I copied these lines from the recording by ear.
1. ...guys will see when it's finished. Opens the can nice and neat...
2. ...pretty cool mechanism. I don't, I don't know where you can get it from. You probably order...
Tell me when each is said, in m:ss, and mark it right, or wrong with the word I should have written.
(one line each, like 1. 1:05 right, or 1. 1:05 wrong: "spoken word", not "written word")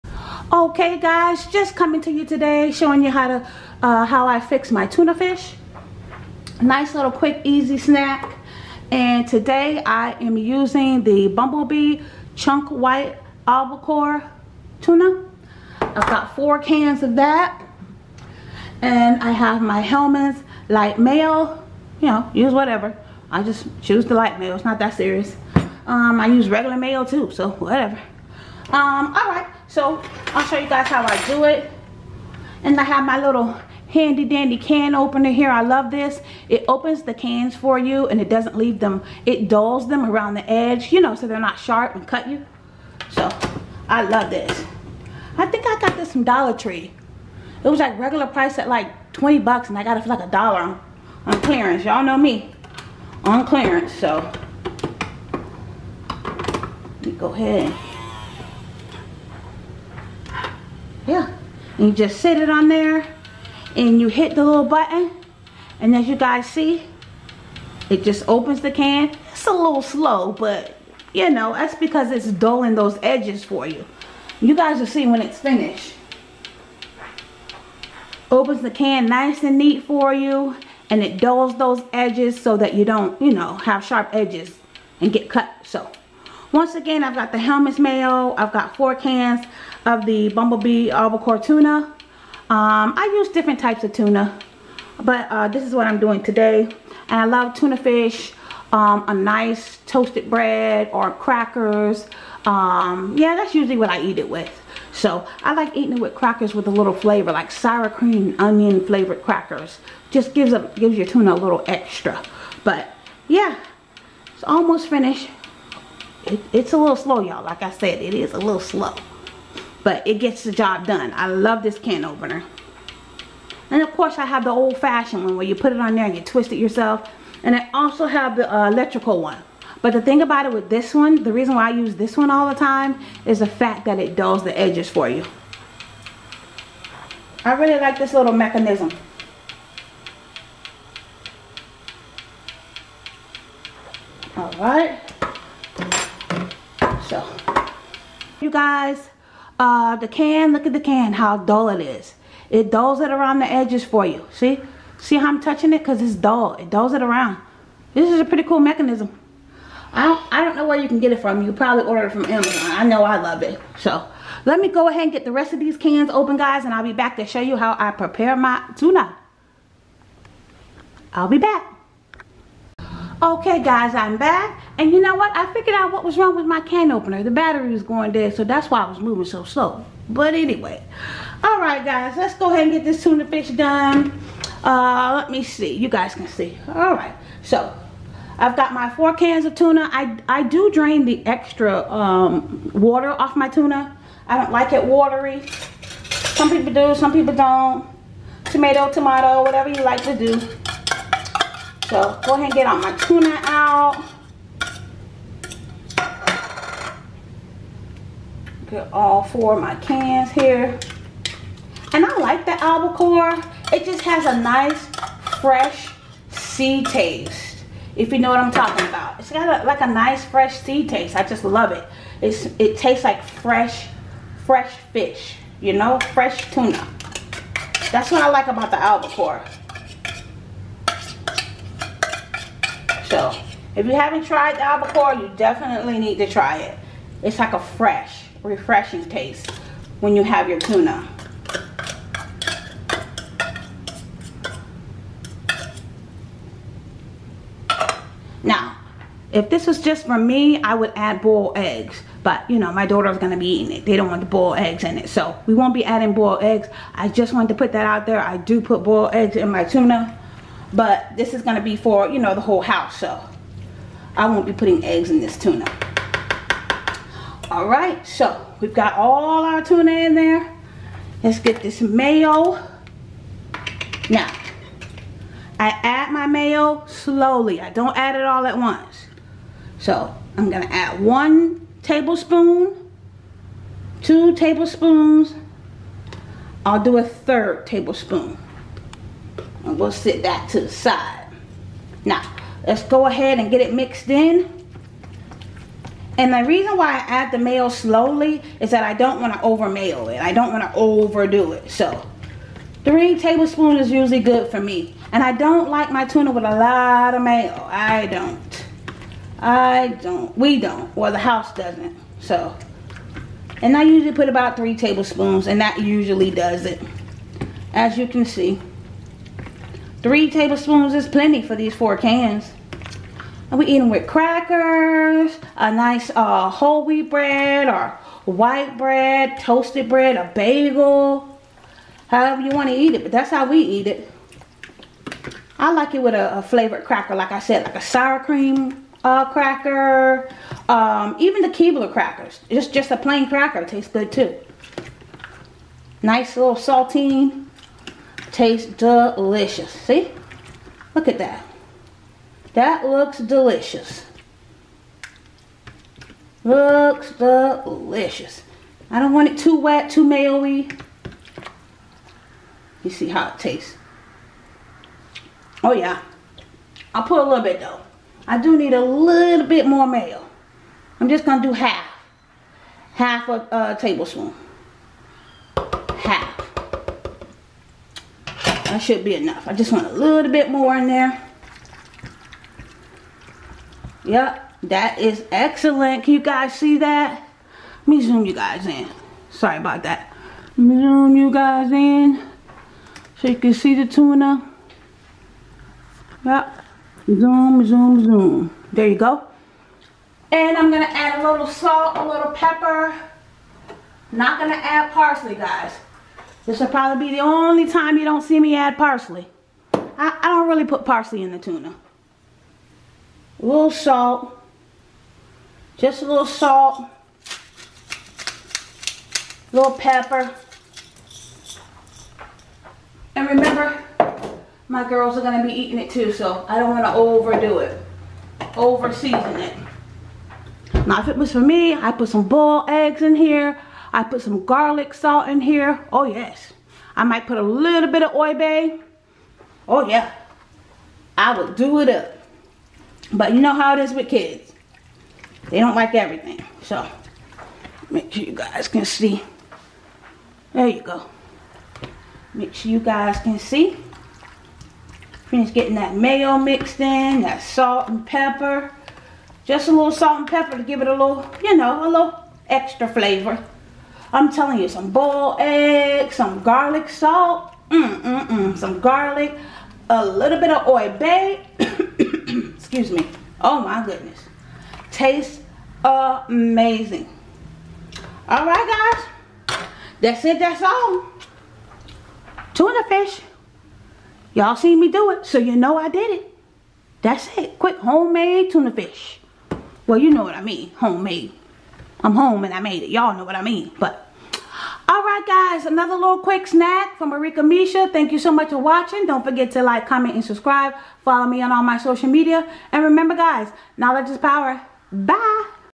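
1. 1:14 right
2. 2:38 right.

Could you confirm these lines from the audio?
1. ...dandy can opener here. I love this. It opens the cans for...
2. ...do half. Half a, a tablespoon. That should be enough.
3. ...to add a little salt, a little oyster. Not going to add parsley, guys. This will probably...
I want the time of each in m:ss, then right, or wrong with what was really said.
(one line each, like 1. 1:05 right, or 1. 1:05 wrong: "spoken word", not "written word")
1. 0:34 right
2. 6:11 right
3. 6:40 wrong: "pepper", not "oyster".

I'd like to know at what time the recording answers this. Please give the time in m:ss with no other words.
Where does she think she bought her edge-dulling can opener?
0:46.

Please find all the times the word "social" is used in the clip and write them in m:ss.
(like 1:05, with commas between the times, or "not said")
8:21.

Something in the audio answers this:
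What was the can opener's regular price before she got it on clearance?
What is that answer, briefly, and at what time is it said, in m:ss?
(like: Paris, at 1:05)
20 bucks, at 0:49.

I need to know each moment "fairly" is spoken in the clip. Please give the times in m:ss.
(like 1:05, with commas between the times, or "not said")
not said.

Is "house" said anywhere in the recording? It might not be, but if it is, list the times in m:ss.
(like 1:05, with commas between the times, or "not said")
4:22, 5:11.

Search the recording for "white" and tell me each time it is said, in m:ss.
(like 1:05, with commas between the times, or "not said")
0:12, 5:28.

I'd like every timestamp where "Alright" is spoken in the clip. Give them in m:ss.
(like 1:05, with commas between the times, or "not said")
3:01, 3:06.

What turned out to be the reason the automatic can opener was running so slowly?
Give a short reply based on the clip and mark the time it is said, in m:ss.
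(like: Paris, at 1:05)
The battery, at 2:57.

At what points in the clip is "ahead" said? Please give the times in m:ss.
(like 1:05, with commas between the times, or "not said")
0:57, 2:44, 3:02, 3:22, 4:53.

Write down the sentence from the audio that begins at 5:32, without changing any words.
However you want to eat it, but that's how we eat it.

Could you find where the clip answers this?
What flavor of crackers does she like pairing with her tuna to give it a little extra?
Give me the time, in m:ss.
1:47.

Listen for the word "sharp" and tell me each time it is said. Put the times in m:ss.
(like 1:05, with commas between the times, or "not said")
0:41, 1:23.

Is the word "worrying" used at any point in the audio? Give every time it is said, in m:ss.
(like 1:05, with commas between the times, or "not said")
not said.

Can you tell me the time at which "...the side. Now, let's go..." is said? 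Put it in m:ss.
4:50.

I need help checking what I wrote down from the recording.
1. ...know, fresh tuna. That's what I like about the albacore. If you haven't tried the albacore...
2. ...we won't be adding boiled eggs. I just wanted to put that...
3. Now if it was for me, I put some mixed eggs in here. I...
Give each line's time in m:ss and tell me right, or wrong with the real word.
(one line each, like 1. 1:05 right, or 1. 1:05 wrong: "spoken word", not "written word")
1. 3:45 right
2. 4:15 right
3. 7:10 wrong: "boiled", not "mixed".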